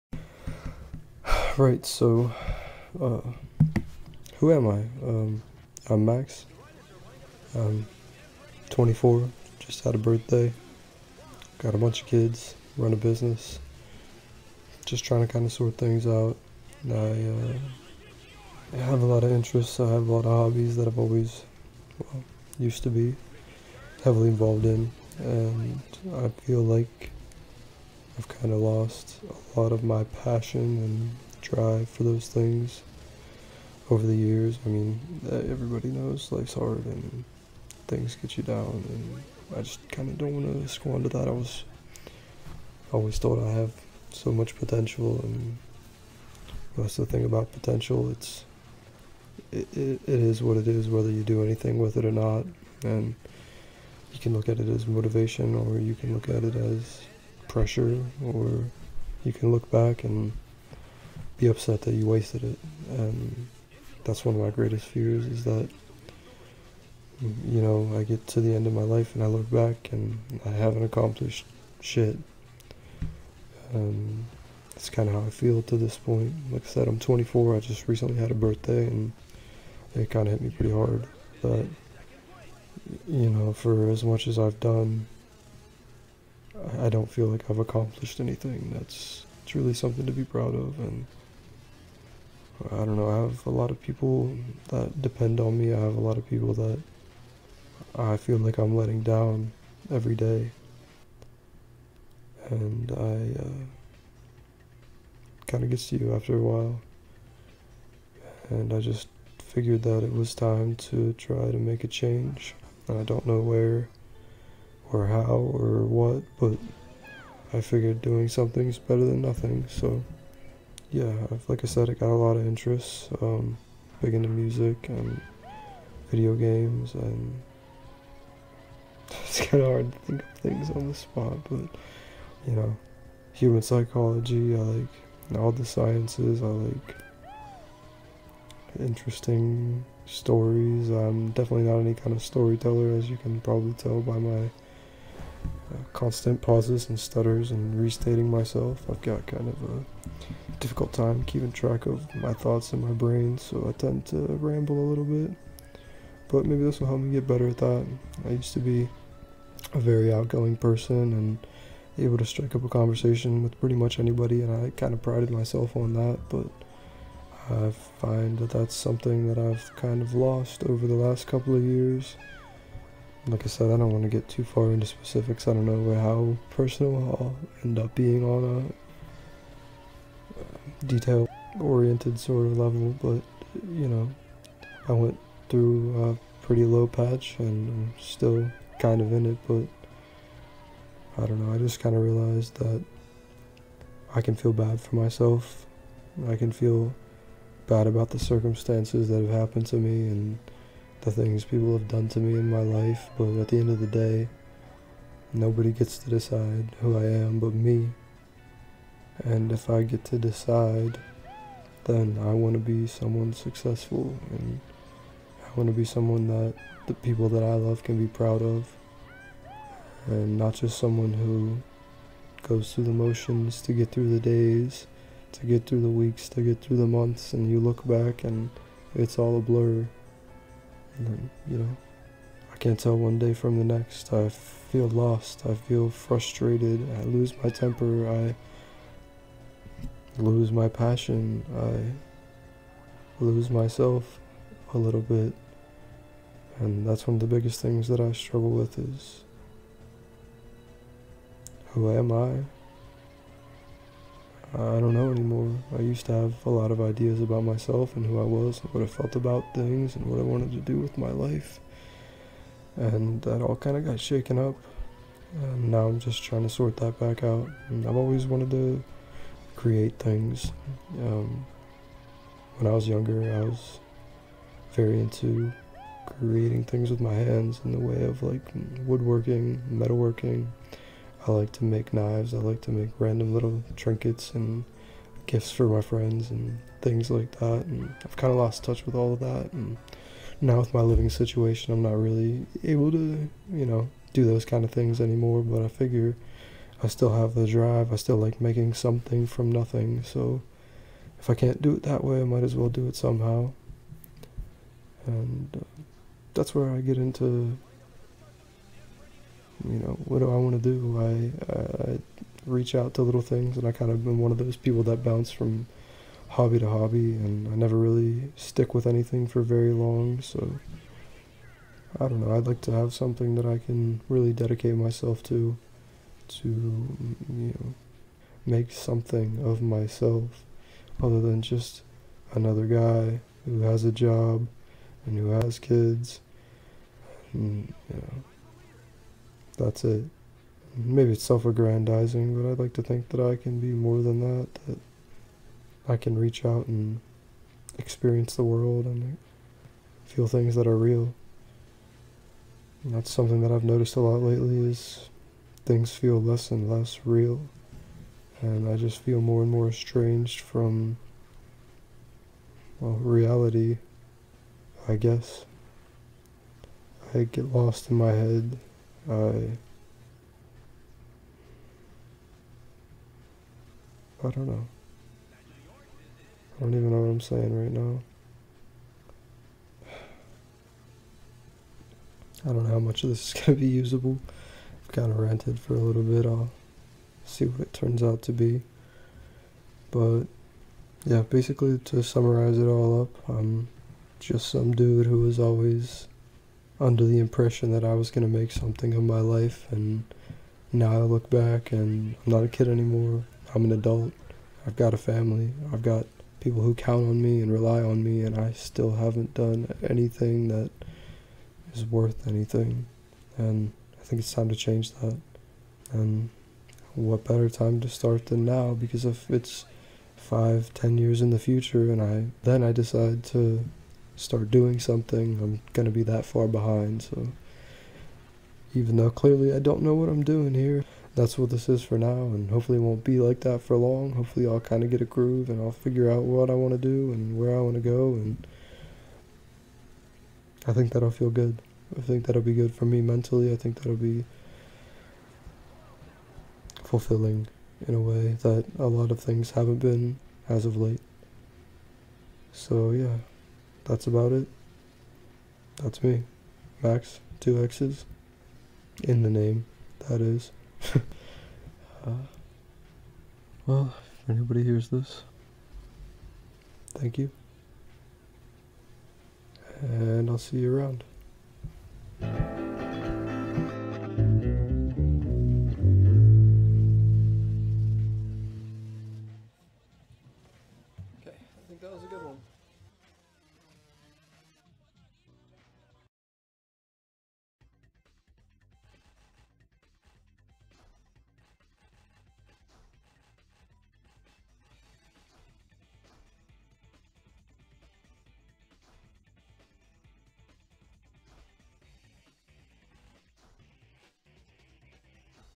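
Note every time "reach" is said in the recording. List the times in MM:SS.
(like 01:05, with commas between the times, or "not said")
05:12, 05:46.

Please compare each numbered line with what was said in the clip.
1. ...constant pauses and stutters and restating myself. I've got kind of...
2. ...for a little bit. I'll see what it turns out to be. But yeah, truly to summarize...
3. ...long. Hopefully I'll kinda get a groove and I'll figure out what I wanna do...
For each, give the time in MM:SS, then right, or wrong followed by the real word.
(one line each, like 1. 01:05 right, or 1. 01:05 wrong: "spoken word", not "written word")
1. 02:25 right
2. 06:25 wrong: "basically", not "truly"
3. 07:13 right.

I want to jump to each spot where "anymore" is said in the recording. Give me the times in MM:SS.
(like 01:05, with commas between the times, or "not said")
04:15, 04:54, 06:42.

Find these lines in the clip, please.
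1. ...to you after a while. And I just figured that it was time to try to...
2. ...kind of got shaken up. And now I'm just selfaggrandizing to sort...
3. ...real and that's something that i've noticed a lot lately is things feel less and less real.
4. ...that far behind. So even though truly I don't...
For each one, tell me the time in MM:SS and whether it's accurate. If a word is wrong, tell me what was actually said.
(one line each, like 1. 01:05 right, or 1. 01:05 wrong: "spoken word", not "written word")
1. 01:45 right
2. 04:23 wrong: "trying", not "selfaggrandizing"
3. 05:50 right
4. 07:06 wrong: "clearly", not "truly".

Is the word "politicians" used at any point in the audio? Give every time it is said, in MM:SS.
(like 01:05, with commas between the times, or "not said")
not said.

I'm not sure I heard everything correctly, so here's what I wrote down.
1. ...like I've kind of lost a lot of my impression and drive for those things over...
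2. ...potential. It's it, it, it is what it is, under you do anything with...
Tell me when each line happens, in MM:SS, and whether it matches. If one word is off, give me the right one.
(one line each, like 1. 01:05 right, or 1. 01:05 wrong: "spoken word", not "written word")
1. 00:26 wrong: "passion", not "impression"
2. 00:47 wrong: "whether", not "under".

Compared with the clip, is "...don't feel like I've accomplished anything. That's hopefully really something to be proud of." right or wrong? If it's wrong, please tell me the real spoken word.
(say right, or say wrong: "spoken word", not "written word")
wrong: "truly", not "hopefully".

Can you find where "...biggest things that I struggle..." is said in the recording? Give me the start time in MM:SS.
04:07.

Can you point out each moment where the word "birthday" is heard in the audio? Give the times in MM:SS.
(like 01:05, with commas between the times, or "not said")
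00:09, 01:18.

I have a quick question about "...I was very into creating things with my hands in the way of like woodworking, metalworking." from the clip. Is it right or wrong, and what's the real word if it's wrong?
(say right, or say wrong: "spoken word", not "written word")
right.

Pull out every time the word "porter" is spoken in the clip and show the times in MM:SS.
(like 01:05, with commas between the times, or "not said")
not said.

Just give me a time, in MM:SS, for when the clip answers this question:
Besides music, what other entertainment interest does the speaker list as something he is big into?
02:06.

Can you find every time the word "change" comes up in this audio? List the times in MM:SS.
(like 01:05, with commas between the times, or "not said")
01:51, 06:54.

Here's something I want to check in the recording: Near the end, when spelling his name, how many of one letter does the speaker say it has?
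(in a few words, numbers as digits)
2.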